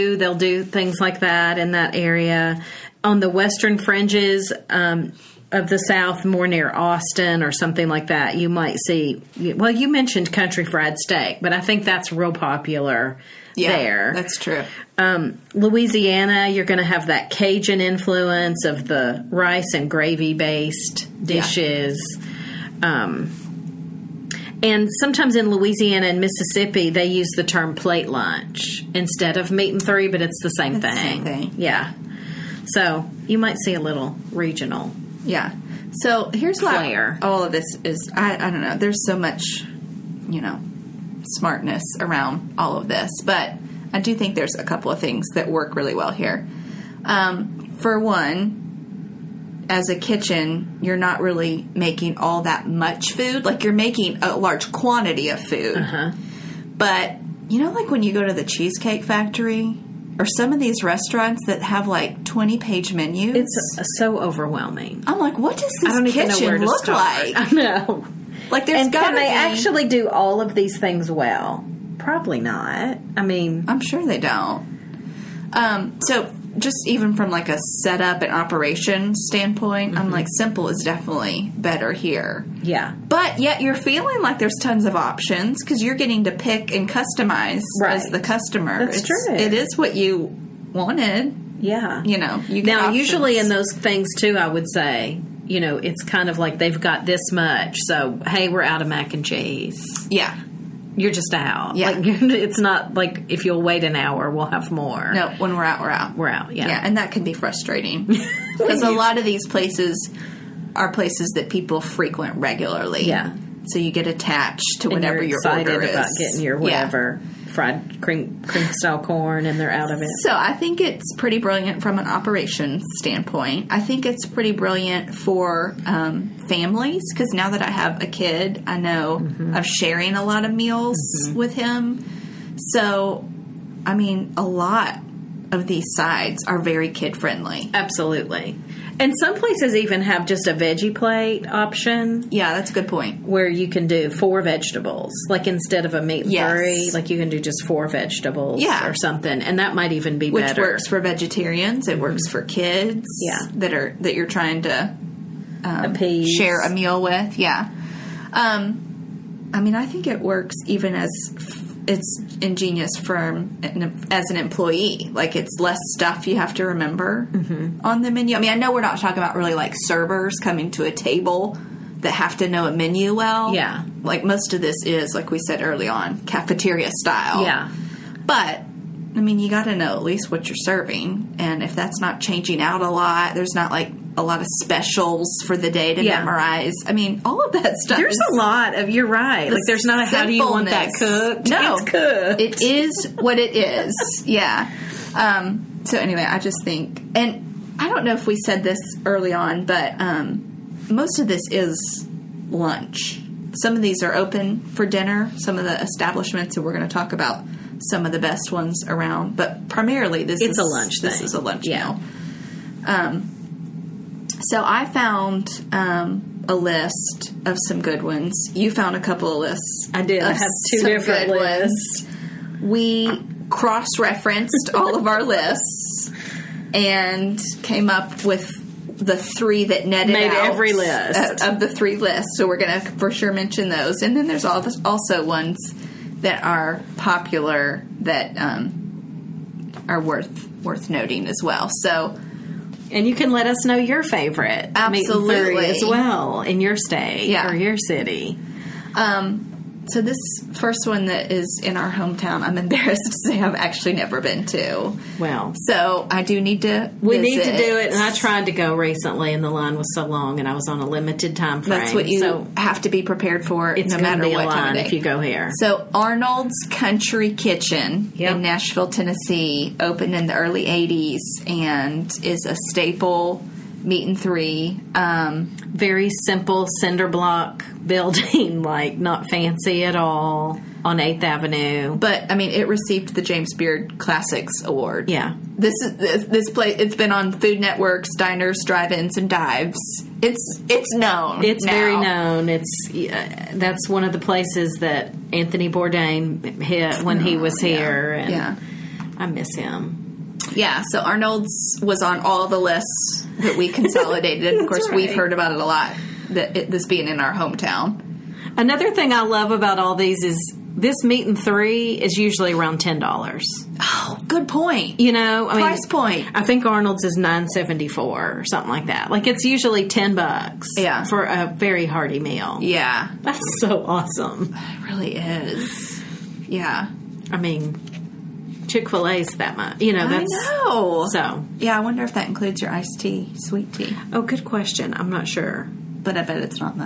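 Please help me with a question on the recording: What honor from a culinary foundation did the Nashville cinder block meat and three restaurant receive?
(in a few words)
James Beard Classics Award.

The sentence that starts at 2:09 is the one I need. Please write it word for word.
I'm sharing a lot of meals mm-hmm.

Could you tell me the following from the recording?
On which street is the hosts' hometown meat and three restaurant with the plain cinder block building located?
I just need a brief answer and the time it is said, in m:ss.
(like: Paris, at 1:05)
8th Avenue, at 4:40.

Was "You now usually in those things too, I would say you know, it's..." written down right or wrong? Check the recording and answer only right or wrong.
right.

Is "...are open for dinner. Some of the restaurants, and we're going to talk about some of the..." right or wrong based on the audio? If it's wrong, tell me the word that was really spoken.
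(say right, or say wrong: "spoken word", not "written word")
wrong: "establishments", not "restaurants".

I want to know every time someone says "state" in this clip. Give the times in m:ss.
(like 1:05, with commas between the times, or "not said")
4:06.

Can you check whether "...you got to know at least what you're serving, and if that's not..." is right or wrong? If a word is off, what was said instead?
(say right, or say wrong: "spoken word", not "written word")
right.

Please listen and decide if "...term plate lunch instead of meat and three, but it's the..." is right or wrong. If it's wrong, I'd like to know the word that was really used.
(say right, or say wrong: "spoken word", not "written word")
right.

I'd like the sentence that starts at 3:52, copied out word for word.
So we're going to for sure mention those.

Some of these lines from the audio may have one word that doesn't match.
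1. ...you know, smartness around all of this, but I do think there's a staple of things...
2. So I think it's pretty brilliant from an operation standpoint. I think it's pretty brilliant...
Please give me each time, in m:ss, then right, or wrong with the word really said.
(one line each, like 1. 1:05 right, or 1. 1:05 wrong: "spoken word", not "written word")
1. 0:40 wrong: "couple", not "staple"
2. 2:00 right.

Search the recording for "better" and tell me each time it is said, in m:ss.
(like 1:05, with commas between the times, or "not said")
1:21, 2:30.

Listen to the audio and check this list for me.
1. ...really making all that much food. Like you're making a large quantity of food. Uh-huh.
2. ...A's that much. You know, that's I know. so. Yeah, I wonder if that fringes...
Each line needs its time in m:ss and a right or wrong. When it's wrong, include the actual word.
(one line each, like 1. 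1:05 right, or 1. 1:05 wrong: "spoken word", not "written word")
1. 0:51 right
2. 5:29 wrong: "includes", not "fringes".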